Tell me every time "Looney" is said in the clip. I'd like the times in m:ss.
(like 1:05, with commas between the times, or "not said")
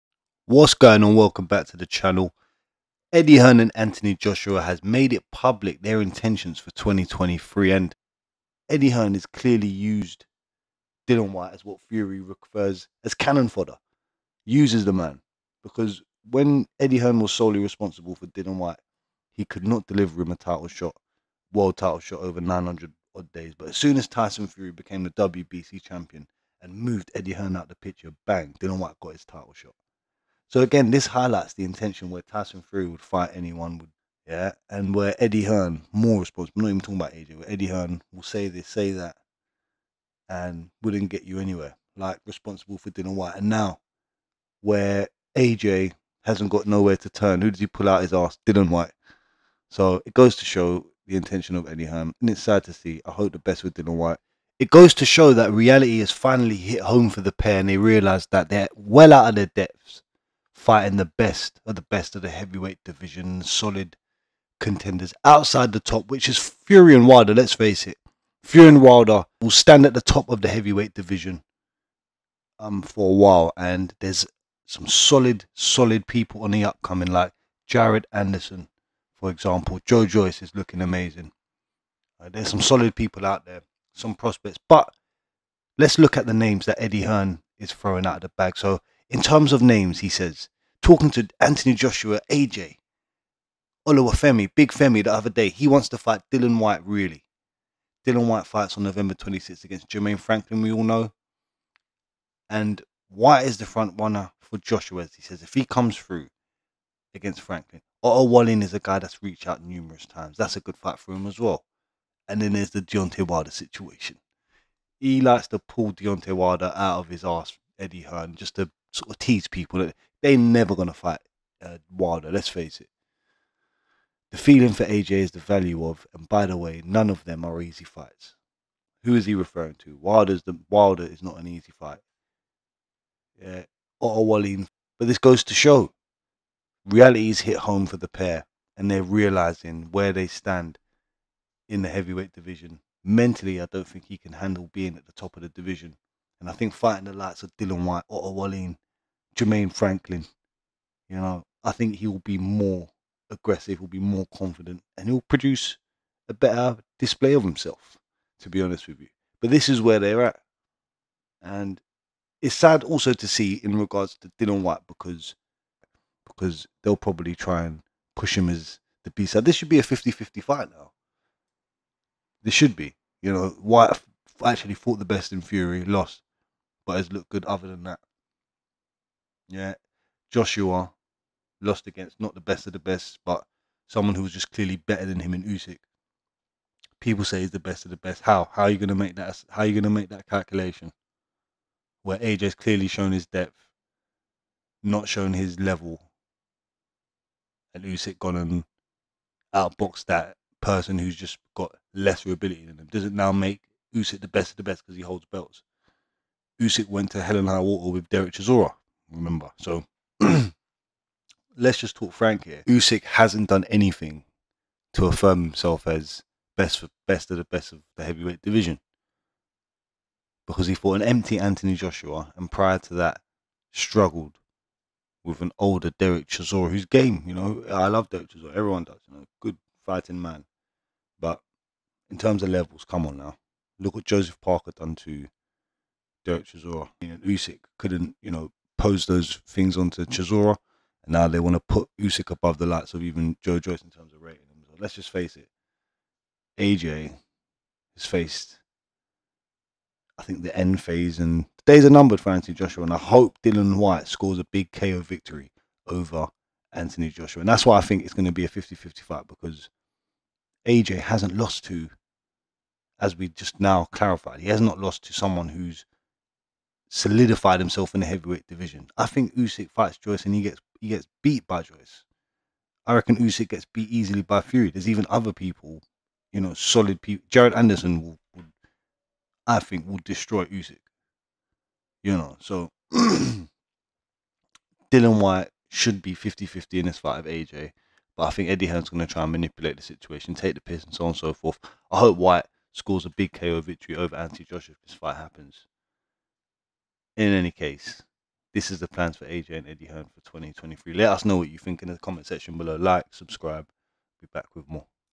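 not said.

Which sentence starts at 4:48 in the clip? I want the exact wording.
But I think Eddie Hearn's going to try and manipulate the situation, take the piss and so on and so forth.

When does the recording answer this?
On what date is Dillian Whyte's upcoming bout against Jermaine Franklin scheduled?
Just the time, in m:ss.
1:38.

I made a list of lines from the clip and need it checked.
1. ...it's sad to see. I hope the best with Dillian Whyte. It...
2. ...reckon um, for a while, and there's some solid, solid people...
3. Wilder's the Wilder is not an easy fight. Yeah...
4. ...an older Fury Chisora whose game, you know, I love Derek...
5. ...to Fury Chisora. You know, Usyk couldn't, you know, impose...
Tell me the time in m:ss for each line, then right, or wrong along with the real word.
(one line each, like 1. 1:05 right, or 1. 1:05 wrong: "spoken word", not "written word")
1. 0:52 right
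2. 1:10 wrong: "division", not "reckon"
3. 2:09 right
4. 3:45 wrong: "Derek", not "Fury"
5. 3:54 wrong: "Derek", not "Fury".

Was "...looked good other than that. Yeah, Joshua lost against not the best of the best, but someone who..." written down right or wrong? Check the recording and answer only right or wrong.
right.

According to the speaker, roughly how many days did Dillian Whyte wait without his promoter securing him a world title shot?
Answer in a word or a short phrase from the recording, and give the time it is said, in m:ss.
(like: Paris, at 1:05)
900, at 0:22.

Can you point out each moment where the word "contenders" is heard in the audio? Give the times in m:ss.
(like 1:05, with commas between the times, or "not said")
1:04.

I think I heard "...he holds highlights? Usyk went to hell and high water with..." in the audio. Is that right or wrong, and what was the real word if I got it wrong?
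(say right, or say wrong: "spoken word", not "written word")
wrong: "belts", not "highlights".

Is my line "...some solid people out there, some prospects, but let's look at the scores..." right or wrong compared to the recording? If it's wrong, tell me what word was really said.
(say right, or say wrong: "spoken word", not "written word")
wrong: "names", not "scores".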